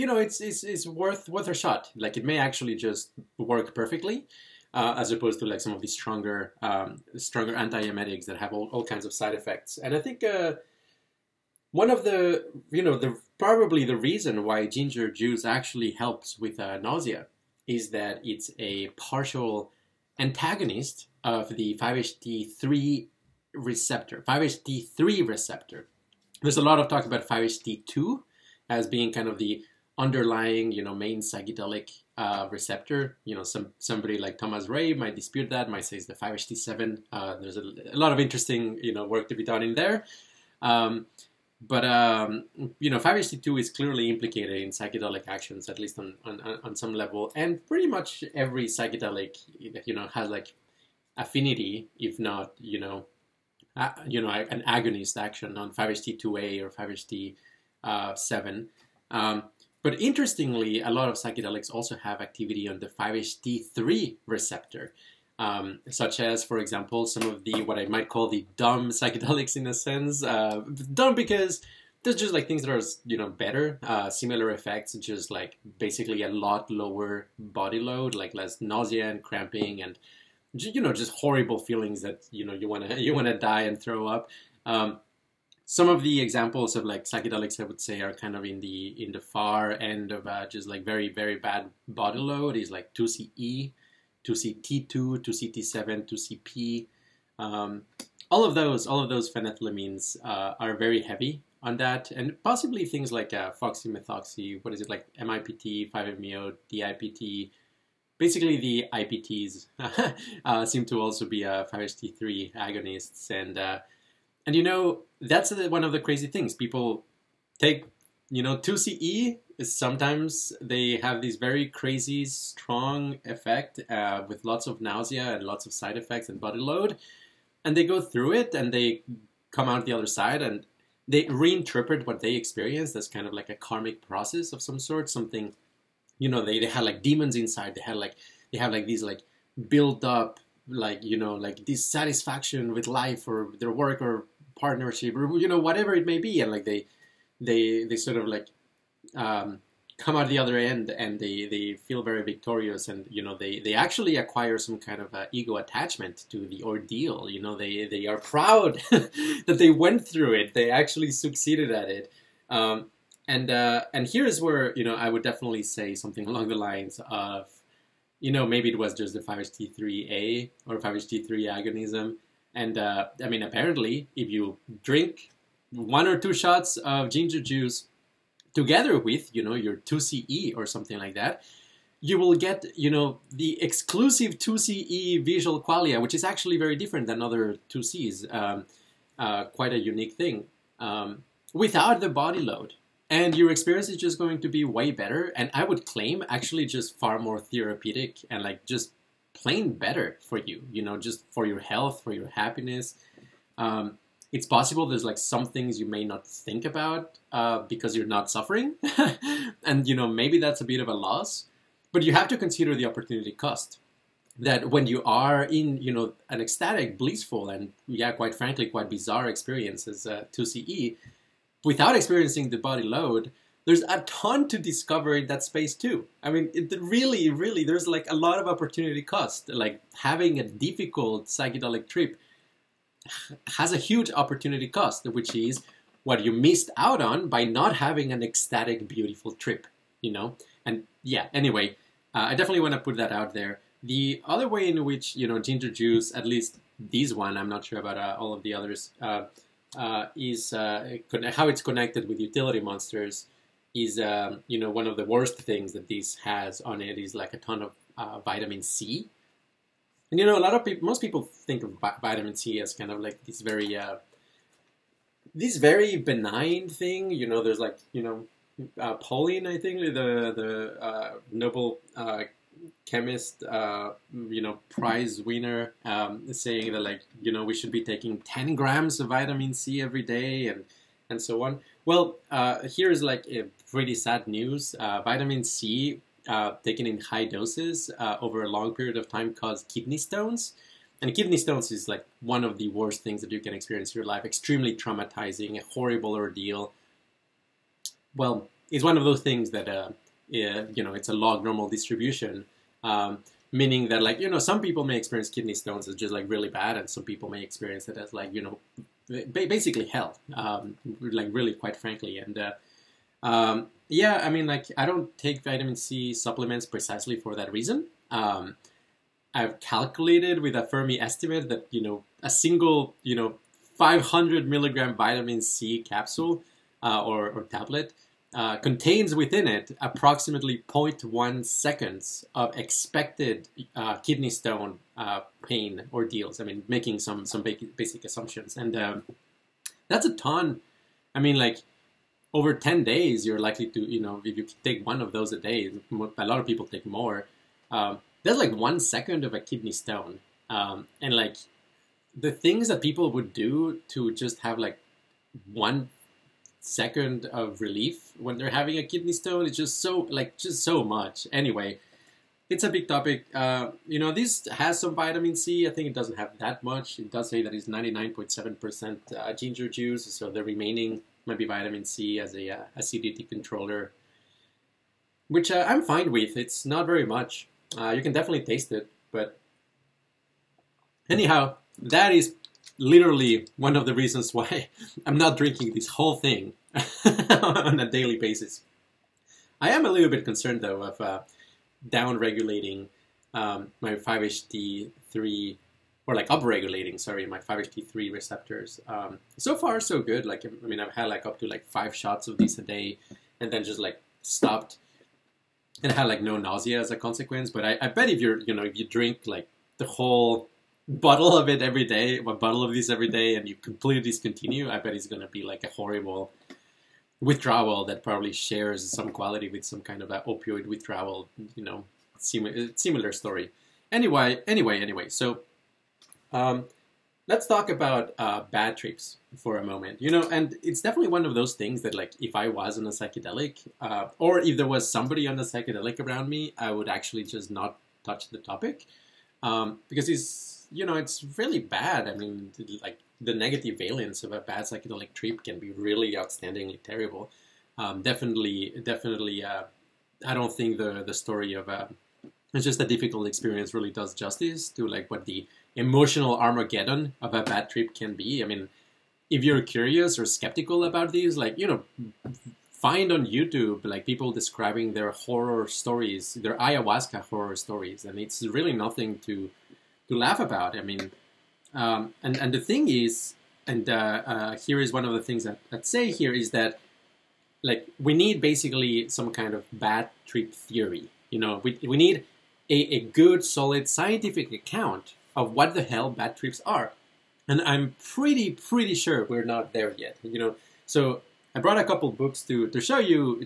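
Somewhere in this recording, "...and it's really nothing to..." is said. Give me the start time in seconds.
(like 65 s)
468 s.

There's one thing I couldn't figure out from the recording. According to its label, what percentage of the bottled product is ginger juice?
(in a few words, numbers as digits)
99.7%.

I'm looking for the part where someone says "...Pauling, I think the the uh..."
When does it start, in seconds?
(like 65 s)
268 s.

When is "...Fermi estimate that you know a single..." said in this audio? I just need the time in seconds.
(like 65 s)
320 s.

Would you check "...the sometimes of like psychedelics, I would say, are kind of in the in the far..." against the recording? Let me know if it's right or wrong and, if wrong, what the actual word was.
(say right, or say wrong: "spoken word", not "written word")
wrong: "examples", not "sometimes".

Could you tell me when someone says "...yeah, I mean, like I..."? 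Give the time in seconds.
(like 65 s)
313 s.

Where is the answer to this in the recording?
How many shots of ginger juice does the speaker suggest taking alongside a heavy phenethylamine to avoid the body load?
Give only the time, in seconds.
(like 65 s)
175 s.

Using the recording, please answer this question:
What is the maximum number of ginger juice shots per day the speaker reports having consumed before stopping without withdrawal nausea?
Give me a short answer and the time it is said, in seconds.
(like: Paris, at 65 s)
5, at 401 s.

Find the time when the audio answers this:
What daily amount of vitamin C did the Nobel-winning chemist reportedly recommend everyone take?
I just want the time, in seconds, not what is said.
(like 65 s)
278 s.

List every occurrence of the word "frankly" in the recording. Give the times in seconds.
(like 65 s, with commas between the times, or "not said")
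218 s, 311 s.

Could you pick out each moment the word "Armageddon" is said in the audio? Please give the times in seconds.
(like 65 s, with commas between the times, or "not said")
456 s.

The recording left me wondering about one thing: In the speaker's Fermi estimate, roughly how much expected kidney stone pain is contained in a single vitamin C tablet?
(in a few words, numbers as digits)
0.1 seconds.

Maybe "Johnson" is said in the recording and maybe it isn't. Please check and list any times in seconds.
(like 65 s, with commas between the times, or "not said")
not said.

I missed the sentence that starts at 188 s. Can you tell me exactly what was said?
Um, uh, quite a unique thing um, without the body load.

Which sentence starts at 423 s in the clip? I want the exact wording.
Anyway, anyway, anyway, so um, let's talk about uh, bad trips for a moment.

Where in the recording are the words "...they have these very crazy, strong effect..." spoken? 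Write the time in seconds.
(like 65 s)
120 s.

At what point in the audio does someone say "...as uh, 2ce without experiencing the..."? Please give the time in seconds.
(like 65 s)
219 s.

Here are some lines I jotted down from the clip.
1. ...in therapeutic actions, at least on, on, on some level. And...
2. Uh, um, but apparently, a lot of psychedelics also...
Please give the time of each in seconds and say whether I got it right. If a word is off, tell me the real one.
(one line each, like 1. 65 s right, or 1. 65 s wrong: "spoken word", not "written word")
1. 44 s wrong: "psychedelic", not "therapeutic"
2. 59 s wrong: "interestingly", not "apparently".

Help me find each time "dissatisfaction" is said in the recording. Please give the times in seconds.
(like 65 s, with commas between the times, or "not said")
141 s.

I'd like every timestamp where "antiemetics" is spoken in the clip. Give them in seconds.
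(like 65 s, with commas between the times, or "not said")
7 s.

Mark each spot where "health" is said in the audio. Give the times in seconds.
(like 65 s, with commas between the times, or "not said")
201 s.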